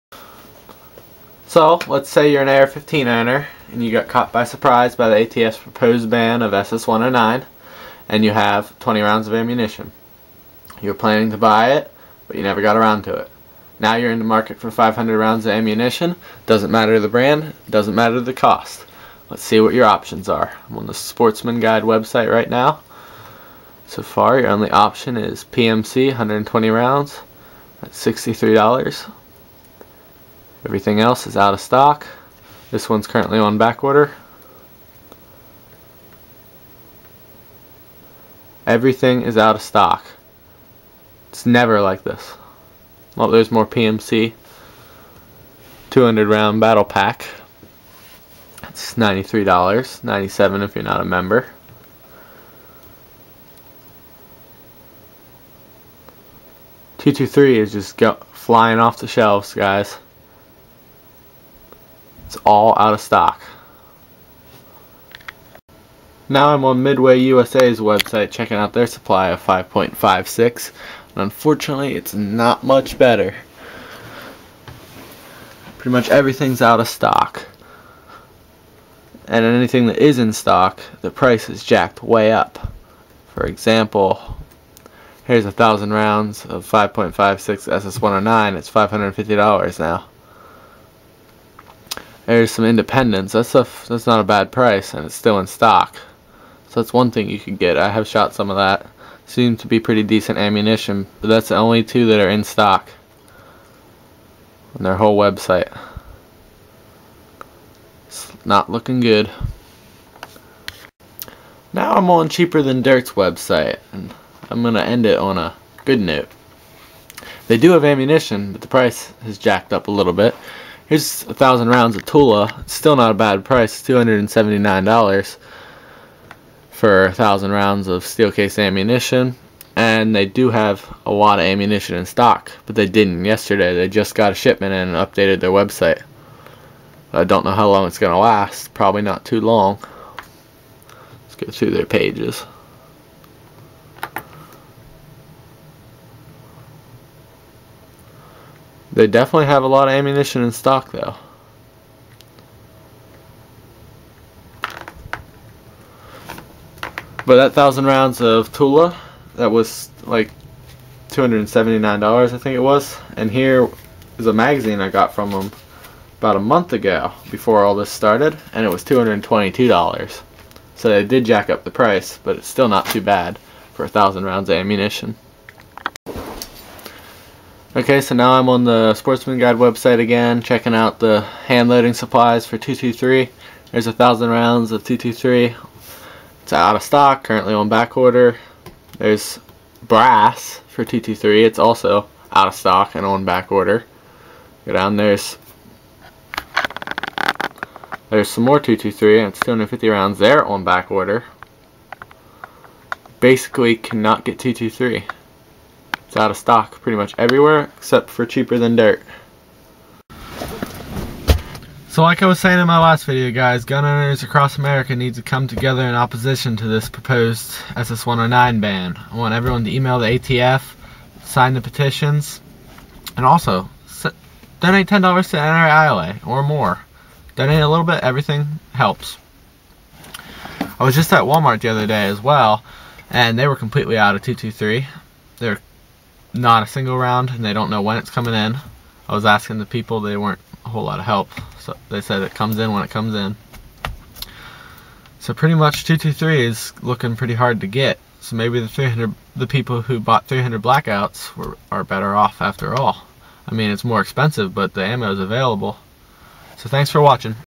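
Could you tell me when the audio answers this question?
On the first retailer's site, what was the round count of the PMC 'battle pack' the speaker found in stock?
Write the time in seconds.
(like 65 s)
45 s.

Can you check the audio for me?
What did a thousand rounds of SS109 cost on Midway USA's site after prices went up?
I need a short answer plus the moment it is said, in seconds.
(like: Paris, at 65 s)
$550, at 88 s.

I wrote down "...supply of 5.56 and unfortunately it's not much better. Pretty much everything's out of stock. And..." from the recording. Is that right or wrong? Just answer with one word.
right.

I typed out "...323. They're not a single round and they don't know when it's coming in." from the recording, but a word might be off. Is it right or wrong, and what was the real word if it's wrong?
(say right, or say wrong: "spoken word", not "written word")
wrong: "223", not "323".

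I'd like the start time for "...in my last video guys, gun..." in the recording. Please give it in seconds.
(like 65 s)
212 s.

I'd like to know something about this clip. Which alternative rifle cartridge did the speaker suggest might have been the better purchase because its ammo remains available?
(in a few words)
300 Blackout.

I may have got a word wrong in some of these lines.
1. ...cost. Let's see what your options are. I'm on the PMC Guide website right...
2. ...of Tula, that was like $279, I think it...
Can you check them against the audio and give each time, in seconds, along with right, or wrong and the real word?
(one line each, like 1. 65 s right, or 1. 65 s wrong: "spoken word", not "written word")
1. 18 s wrong: "Sportsman", not "PMC"
2. 158 s right.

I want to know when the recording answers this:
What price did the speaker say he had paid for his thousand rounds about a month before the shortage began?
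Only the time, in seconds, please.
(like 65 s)
168 s.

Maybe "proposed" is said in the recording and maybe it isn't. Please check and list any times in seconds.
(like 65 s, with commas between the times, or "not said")
5 s, 216 s.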